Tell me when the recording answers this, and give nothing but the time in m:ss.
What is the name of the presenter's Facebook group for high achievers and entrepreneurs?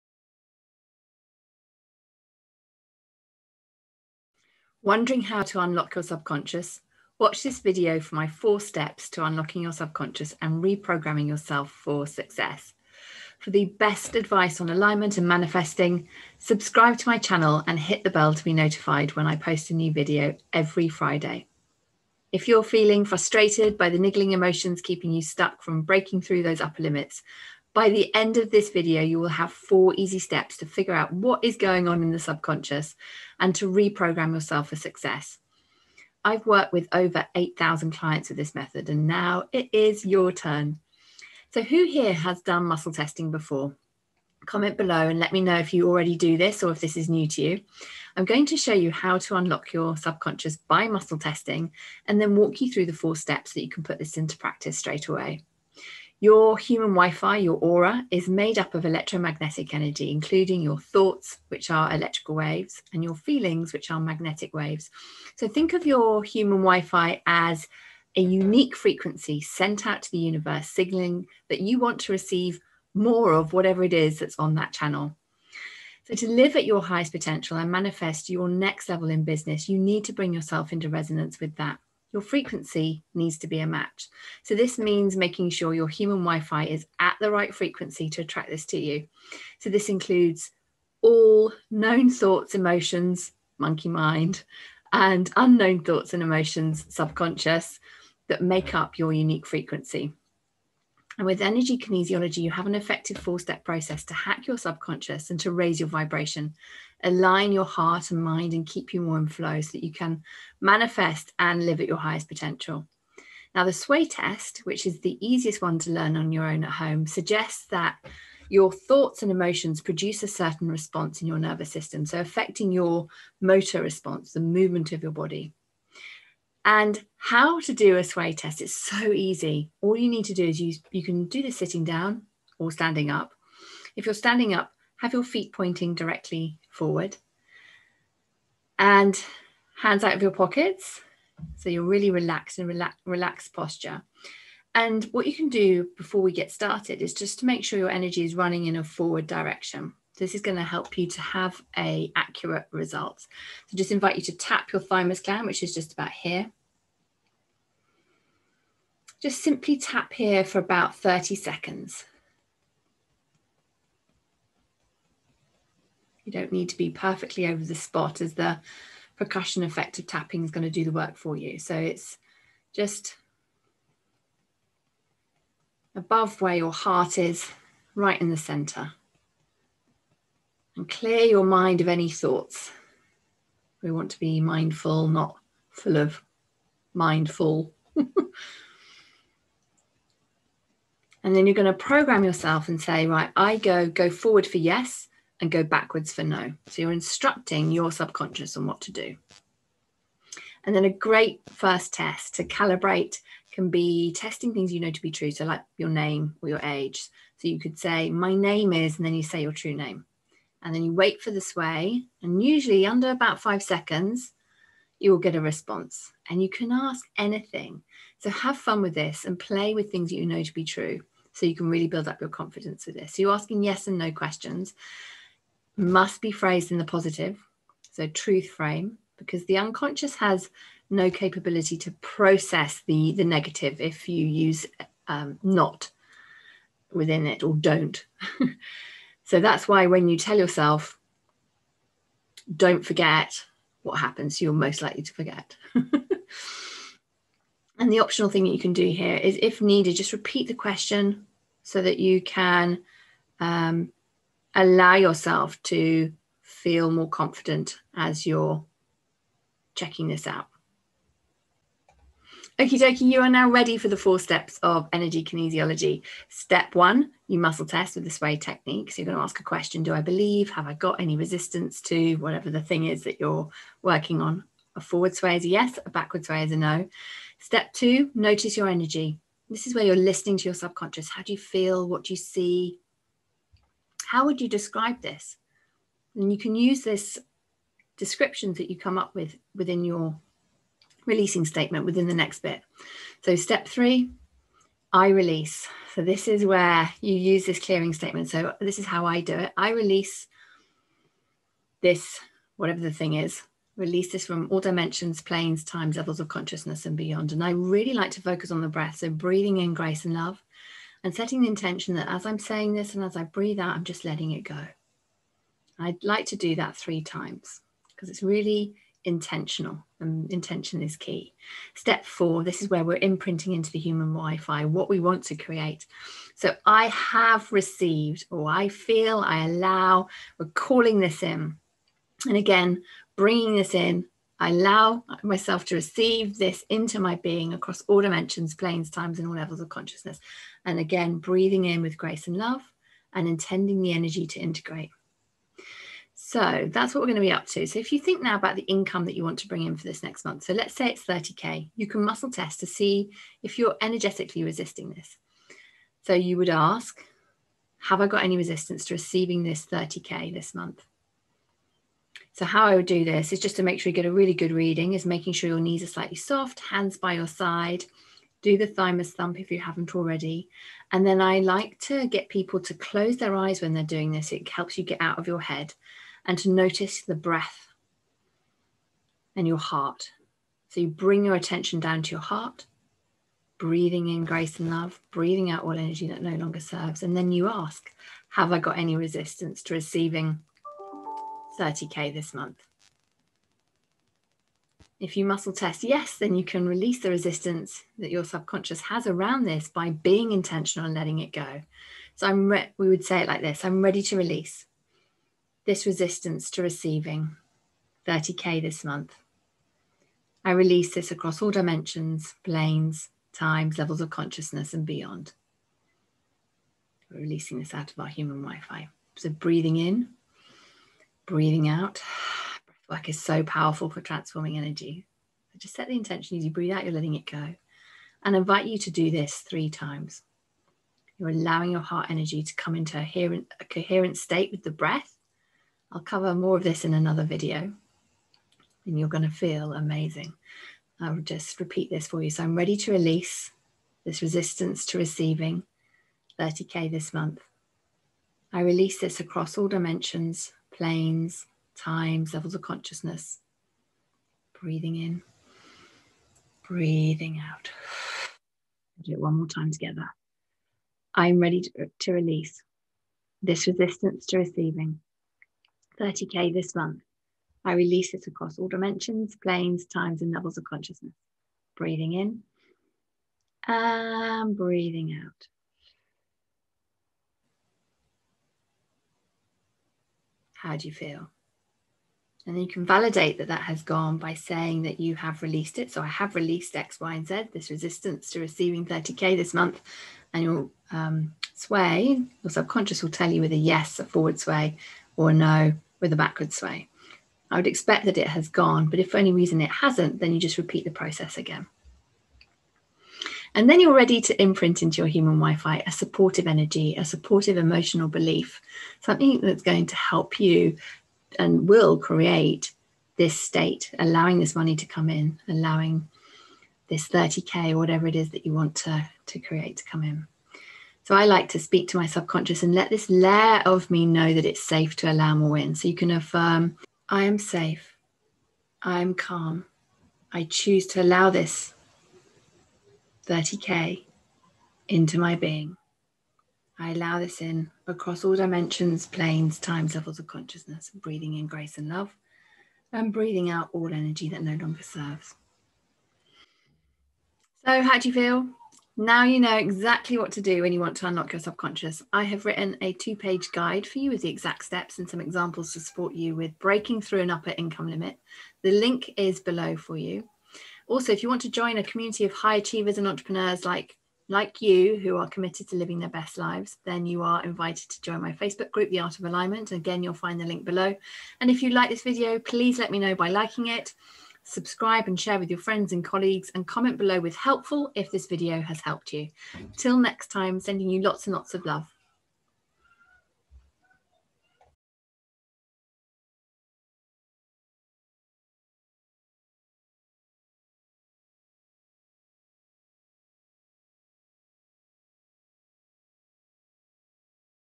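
9:28.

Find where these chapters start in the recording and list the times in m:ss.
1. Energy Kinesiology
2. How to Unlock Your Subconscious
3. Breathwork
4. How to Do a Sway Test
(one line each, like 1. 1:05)
1. 4:23
2. 0:12
3. 6:02
4. 2:07.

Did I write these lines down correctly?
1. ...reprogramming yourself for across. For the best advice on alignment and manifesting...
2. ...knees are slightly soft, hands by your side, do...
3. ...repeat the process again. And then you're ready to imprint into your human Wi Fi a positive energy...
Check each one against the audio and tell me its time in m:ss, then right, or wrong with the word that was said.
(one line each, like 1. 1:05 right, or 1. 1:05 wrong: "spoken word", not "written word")
1. 0:10 wrong: "success", not "across"
2. 6:05 right
3. 8:20 wrong: "supportive", not "positive".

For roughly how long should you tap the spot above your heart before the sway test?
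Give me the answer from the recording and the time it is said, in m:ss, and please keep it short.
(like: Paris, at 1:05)
30 seconds, at 2:40.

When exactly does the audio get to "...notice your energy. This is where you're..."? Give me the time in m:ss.
4:38.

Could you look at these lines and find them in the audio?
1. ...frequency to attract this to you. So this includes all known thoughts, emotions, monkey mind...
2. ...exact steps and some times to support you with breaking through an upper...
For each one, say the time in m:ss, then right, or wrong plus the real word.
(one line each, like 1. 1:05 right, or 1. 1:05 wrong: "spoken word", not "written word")
1. 1:27 right
2. 9:14 wrong: "examples", not "times".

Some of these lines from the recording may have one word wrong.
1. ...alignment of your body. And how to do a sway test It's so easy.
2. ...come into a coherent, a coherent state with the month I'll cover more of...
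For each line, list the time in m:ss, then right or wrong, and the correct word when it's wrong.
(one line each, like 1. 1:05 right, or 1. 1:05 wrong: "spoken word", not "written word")
1. 2:04 wrong: "movement", not "alignment"
2. 7:12 wrong: "breath", not "month".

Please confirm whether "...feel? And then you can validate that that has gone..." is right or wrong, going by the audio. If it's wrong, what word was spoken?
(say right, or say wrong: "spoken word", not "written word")
right.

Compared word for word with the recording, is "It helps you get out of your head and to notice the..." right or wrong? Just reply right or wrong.
right.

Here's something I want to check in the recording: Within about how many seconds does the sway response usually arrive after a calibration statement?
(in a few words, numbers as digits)
5 seconds.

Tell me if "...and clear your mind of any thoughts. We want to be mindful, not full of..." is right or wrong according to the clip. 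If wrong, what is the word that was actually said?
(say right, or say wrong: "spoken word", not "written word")
right.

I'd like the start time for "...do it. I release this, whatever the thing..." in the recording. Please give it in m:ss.
4:59.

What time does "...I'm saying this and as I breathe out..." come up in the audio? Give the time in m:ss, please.
5:12.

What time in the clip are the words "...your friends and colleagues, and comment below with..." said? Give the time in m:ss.
9:35.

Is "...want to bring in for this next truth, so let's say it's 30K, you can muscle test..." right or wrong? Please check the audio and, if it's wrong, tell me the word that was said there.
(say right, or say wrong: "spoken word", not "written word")
wrong: "month", not "truth".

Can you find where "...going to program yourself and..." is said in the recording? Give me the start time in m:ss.
3:11.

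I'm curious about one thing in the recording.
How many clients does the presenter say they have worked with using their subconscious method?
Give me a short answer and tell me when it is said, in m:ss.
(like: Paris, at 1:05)
8,000, at 0:37.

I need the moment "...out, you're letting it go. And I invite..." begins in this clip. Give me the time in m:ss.
7:06.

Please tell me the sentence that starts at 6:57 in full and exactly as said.
We're releasing this out of our human Wi Fi.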